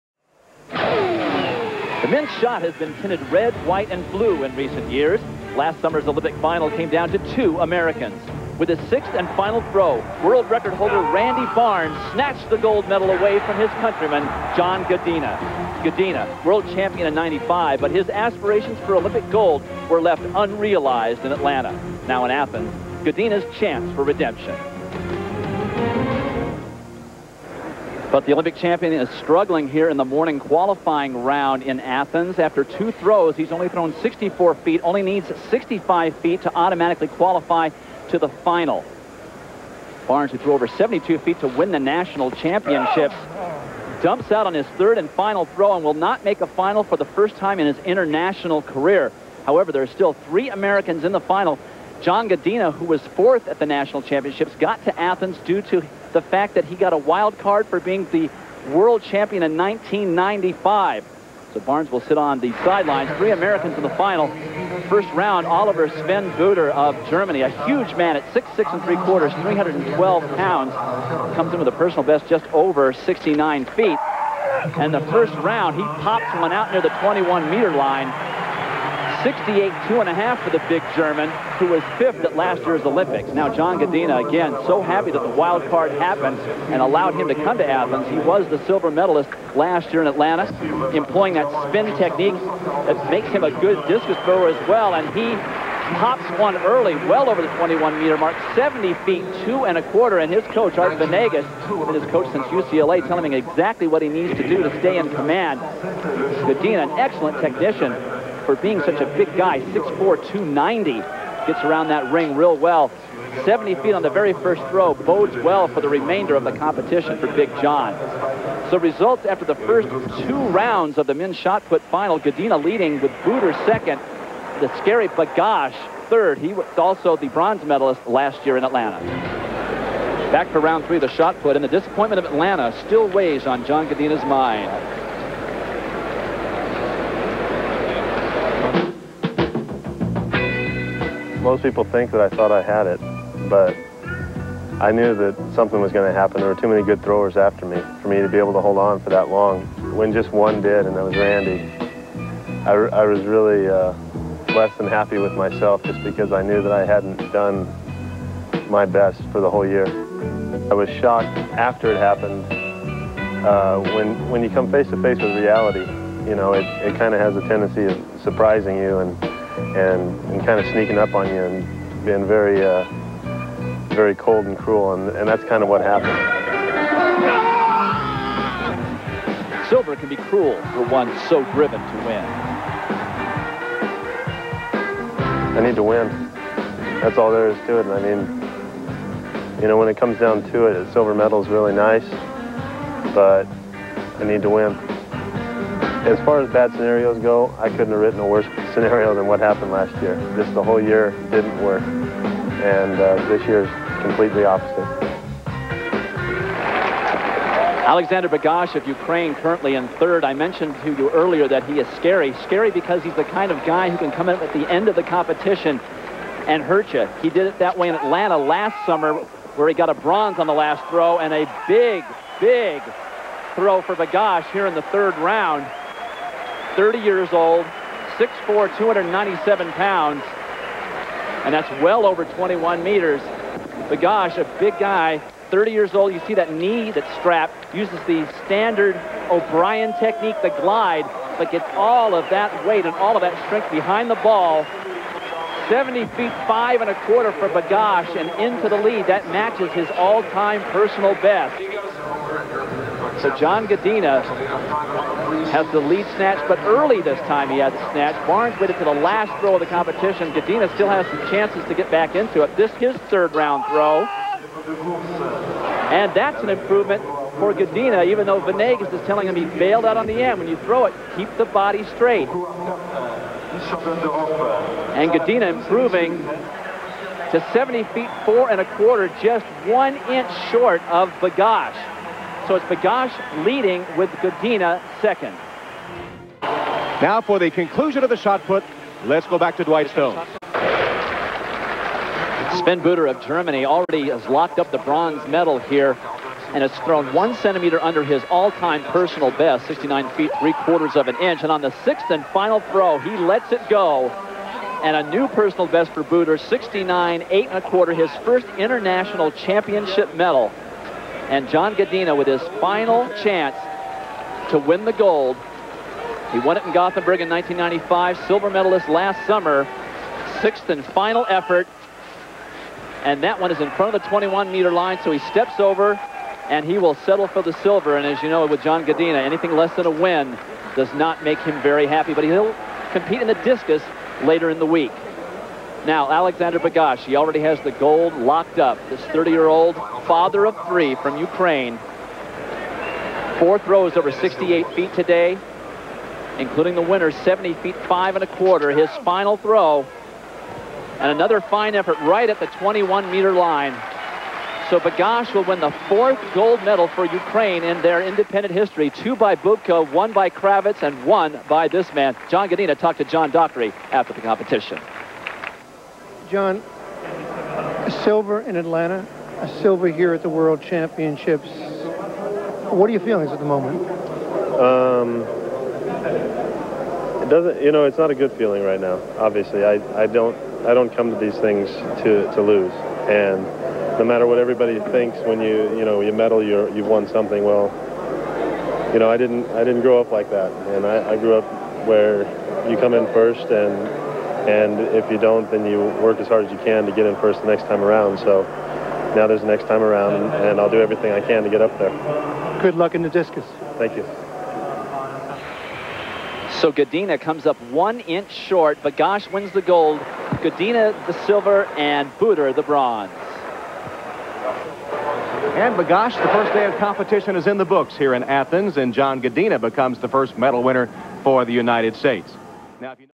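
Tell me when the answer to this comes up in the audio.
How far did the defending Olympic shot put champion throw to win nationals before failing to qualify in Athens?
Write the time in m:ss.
0:40.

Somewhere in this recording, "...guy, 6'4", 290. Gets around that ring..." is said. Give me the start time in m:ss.
1:49.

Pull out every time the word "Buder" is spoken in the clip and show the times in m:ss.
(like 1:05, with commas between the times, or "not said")
1:06, 2:03, 4:52, 5:06, 6:52.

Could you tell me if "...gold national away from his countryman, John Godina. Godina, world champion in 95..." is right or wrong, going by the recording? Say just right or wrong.
wrong.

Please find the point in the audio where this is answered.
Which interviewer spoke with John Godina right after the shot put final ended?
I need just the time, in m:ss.
6:03.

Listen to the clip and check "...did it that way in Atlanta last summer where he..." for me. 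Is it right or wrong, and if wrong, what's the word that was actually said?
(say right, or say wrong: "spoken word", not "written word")
right.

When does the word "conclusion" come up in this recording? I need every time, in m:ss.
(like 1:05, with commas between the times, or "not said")
4:47.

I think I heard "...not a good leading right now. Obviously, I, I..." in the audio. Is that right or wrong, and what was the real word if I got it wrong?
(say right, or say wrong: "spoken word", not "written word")
wrong: "feeling", not "leading".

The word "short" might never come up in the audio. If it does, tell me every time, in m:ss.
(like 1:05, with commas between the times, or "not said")
4:40, 6:48.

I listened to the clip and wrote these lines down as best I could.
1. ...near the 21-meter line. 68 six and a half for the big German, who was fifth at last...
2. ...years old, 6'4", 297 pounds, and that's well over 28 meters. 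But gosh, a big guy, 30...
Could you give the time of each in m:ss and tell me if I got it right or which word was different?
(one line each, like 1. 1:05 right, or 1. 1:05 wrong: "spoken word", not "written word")
1. 1:16 wrong: "two", not "six"
2. 3:46 wrong: "21", not "28".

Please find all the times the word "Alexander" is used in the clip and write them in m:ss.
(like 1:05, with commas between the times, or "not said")
3:27, 5:36.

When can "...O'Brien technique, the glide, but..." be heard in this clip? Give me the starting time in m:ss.
3:59.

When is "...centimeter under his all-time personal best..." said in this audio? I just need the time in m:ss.
4:57.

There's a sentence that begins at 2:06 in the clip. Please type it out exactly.
He was also the bronze medalist last year in Atlanta.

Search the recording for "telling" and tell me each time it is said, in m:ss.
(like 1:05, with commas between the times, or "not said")
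1:43, 4:29.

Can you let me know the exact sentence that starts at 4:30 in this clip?
When you throw it, keep the body straight.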